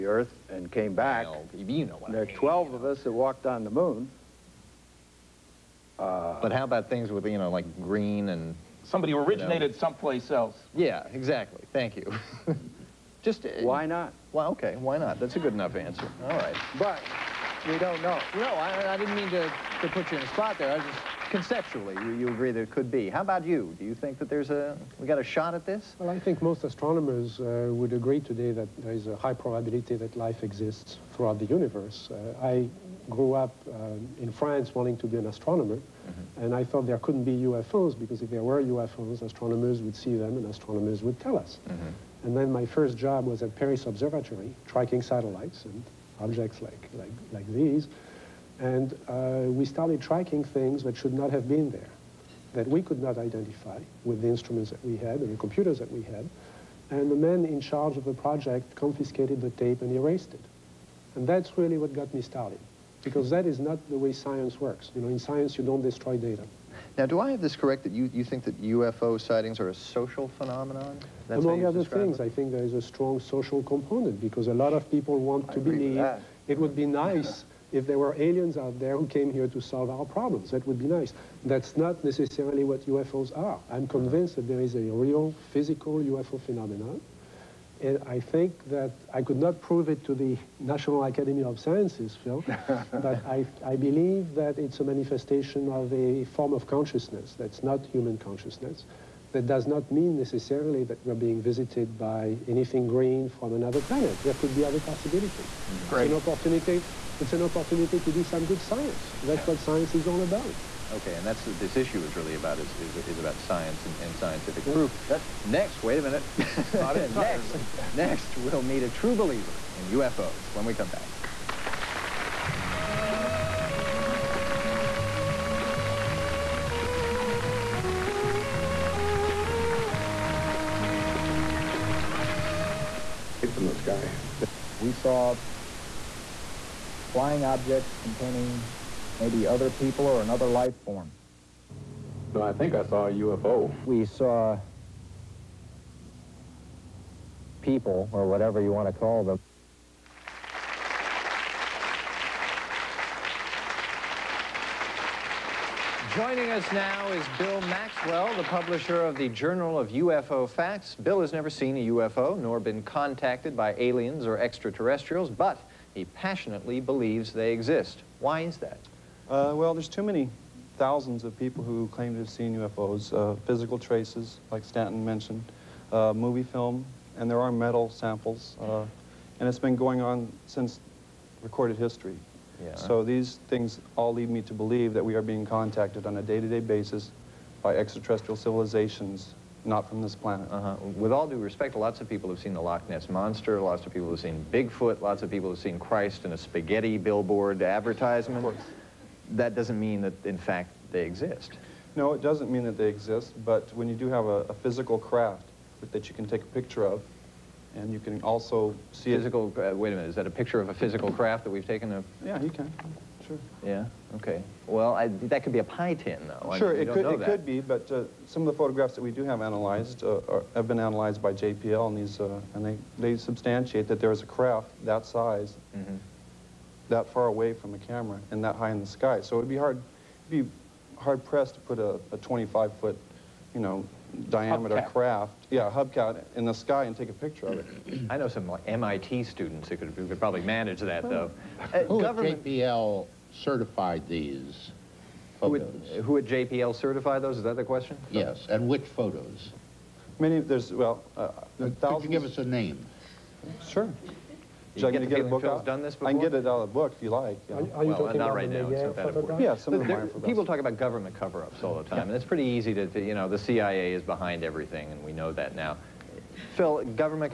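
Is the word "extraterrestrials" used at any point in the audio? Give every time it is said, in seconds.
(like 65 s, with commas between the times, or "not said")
164 s, 187 s.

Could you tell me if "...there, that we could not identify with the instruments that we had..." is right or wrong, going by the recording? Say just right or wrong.
right.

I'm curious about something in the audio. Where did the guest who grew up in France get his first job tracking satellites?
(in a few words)
Paris Observatory.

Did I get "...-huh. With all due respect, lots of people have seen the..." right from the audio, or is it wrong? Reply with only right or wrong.
right.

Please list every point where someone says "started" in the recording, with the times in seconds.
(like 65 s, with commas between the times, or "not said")
49 s, 62 s.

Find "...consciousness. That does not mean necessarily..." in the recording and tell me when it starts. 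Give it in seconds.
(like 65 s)
98 s.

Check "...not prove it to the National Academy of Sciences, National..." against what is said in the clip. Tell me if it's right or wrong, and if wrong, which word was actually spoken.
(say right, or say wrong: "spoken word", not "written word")
wrong: "Phil", not "National".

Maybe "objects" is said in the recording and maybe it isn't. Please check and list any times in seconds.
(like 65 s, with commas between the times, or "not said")
46 s, 137 s.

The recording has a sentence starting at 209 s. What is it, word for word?
uh, wait a minute, is that a picture of a physical craft that we've taken?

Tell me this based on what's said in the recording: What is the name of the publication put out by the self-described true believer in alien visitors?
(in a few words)
Journal of UFO Facts.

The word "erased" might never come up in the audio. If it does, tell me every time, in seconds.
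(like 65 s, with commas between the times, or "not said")
59 s.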